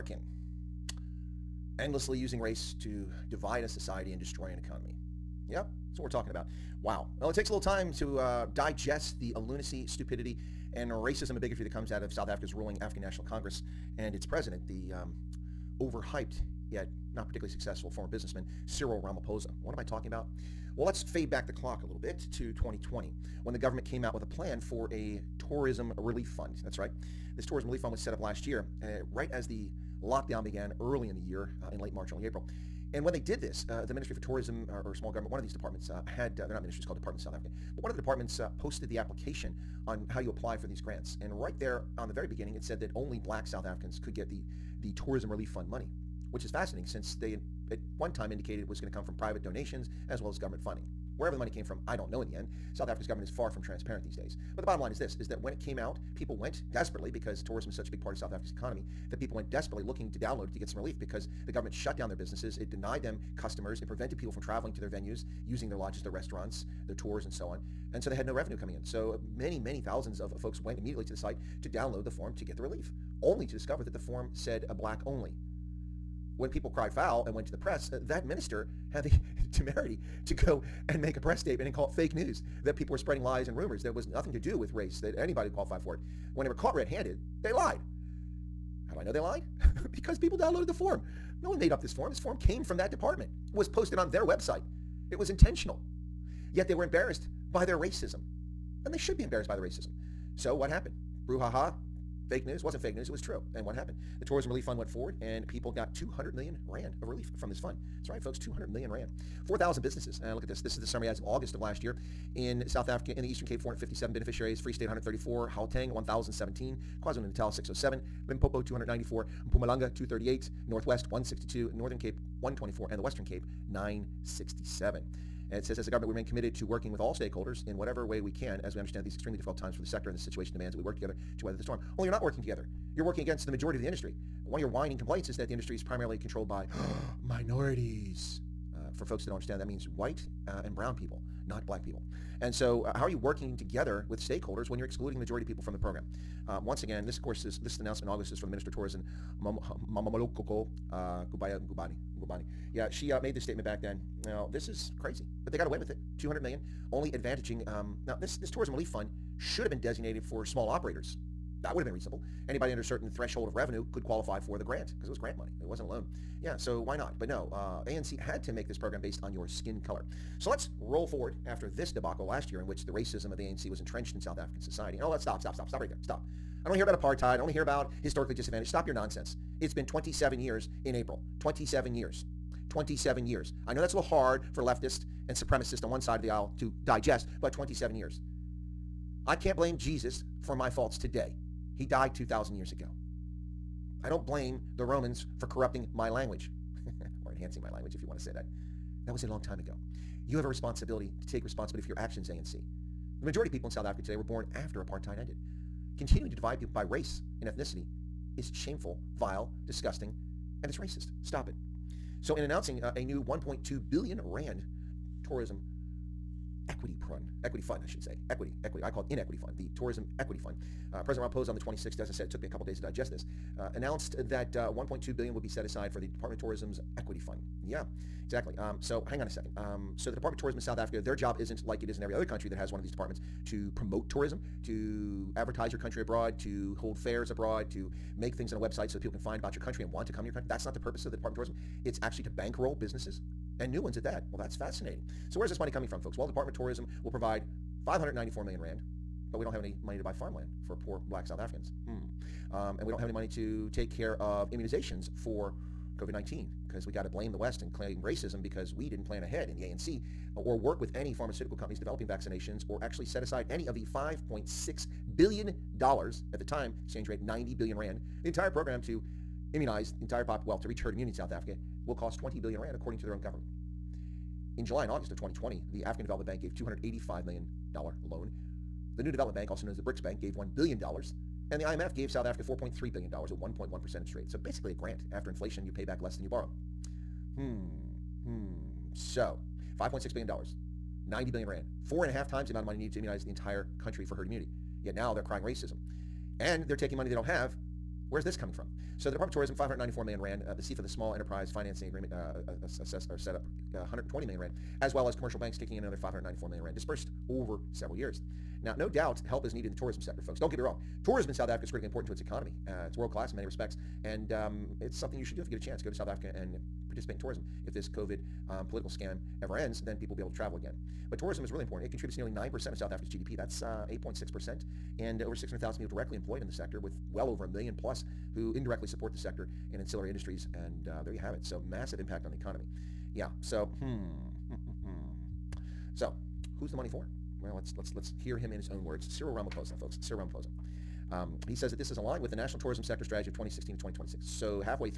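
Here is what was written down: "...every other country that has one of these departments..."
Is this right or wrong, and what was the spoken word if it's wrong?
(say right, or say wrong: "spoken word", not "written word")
right.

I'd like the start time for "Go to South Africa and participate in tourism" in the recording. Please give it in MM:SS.
05:15.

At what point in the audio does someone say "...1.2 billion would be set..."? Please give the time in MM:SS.
03:44.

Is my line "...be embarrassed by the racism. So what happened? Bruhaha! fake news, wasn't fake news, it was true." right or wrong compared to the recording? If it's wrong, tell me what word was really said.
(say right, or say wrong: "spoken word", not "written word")
right.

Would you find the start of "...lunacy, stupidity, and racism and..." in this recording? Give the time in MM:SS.
00:09.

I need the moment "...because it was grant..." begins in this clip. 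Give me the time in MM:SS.
02:44.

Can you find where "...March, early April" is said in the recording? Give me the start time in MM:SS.
00:31.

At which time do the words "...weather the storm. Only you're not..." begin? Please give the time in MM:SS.
02:11.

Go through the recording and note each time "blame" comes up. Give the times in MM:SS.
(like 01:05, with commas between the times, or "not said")
03:09, 03:14, 04:17.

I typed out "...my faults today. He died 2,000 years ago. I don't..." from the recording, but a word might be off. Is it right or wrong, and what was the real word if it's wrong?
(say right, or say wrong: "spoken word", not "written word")
right.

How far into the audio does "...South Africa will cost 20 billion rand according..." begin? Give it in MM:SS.
04:31.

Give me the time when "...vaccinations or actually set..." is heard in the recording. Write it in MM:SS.
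04:22.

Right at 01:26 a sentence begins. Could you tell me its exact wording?
When they were caught red-handed, they lied.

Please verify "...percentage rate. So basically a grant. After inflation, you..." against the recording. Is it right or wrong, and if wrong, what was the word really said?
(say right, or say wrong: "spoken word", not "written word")
right.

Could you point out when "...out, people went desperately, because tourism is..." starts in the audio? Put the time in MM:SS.
00:55.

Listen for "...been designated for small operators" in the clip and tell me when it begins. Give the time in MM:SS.
02:39.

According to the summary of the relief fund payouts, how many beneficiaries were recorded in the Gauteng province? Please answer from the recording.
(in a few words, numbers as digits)
1,017.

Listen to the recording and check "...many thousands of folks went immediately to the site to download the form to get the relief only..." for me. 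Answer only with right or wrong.
right.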